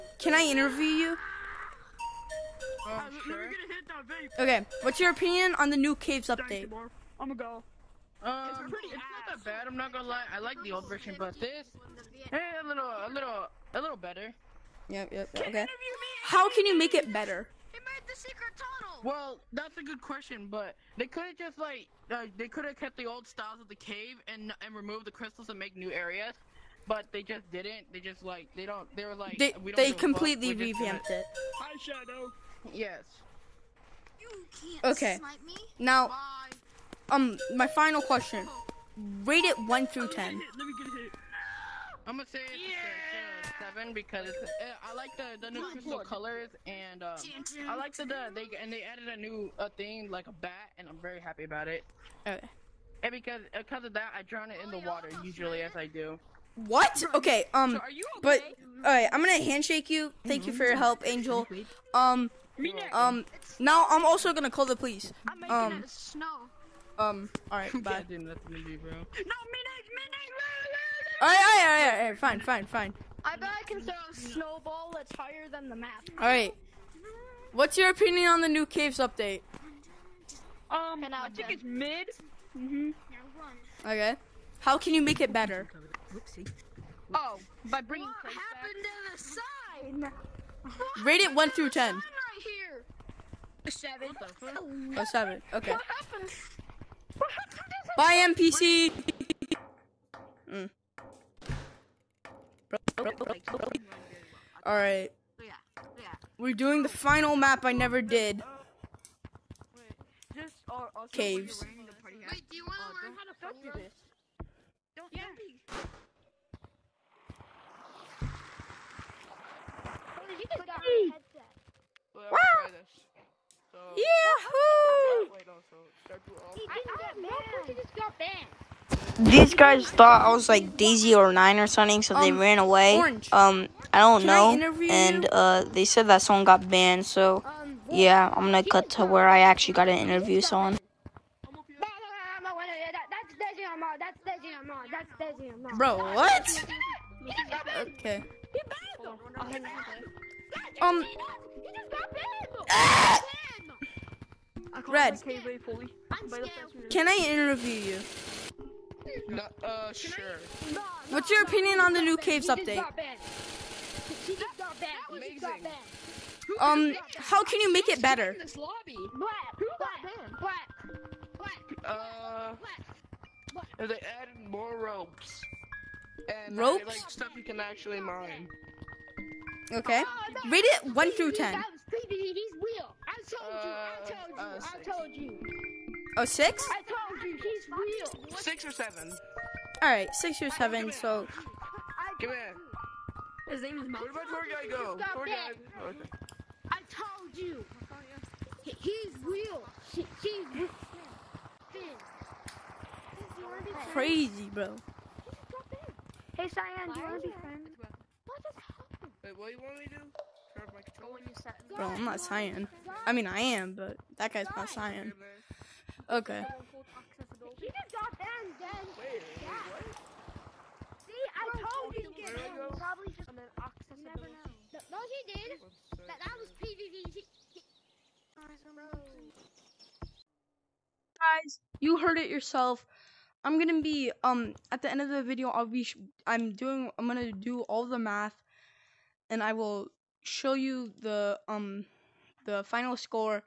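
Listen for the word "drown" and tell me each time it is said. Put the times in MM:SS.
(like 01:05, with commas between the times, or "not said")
00:54.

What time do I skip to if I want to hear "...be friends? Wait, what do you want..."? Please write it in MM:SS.
03:27.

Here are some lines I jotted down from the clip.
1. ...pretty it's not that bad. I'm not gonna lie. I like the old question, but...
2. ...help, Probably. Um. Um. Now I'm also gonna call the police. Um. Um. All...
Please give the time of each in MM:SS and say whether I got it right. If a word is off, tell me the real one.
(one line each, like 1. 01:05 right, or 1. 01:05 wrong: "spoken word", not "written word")
1. 00:08 wrong: "version", not "question"
2. 01:00 wrong: "Angel", not "Probably".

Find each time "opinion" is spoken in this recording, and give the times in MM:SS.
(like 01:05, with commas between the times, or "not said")
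00:05, 01:17, 02:41.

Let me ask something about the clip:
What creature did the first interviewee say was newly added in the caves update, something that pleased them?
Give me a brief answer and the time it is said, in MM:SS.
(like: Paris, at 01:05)
bat, at 00:50.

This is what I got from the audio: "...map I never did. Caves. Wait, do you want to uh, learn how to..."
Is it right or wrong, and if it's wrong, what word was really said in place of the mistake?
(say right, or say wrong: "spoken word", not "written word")
right.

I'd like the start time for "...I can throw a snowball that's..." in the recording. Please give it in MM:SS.
01:13.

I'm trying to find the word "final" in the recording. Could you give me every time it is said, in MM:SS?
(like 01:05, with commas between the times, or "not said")
00:37, 01:46, 04:02.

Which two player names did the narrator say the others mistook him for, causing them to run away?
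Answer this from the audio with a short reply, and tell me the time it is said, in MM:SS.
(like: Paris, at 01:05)
Daisy or Nine, at 02:10.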